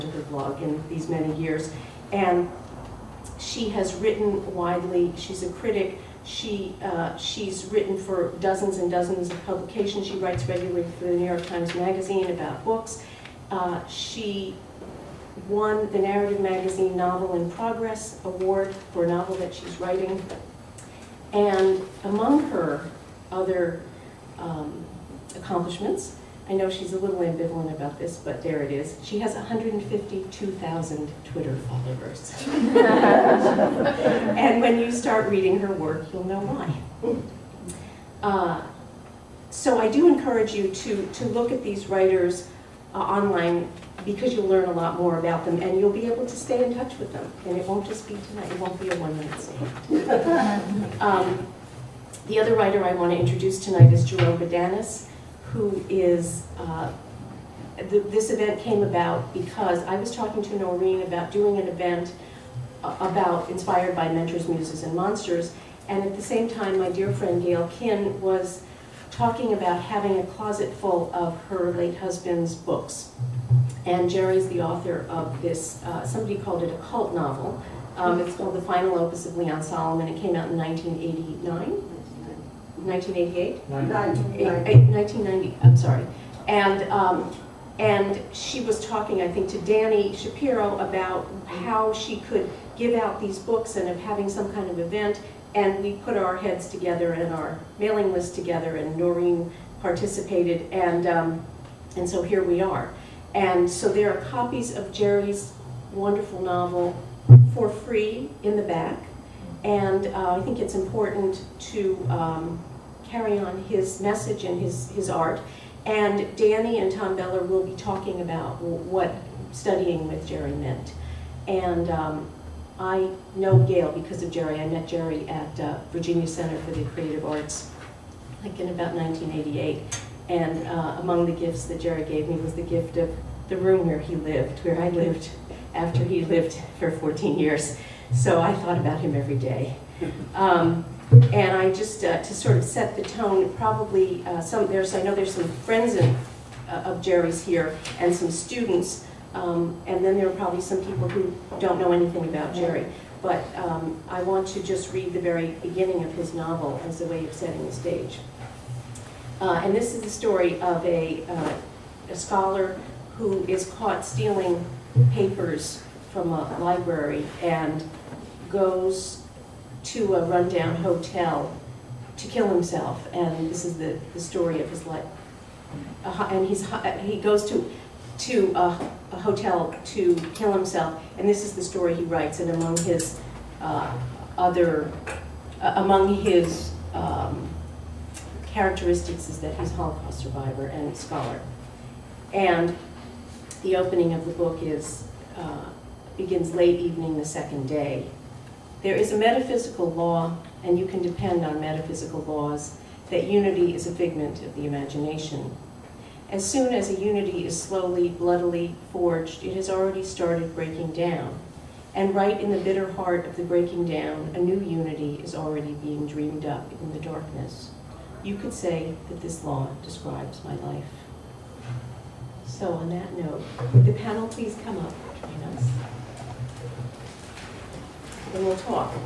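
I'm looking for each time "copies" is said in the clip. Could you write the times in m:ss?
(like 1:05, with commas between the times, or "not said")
1:44.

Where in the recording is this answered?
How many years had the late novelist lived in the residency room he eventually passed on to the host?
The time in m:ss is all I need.
2:16.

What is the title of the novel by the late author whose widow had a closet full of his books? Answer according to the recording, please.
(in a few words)
The Final Opus of Leon Solomon.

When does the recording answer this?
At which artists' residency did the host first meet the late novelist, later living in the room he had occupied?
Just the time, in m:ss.
2:05.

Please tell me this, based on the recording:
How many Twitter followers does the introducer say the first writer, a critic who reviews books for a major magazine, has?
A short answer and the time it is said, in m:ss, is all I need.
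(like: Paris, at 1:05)
152,000, at 0:29.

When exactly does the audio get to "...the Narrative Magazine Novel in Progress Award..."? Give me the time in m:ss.
0:15.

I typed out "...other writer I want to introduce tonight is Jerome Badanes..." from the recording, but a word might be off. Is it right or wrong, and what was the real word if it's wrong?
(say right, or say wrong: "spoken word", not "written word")
right.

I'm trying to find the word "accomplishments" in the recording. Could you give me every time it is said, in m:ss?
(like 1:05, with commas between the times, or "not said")
0:25.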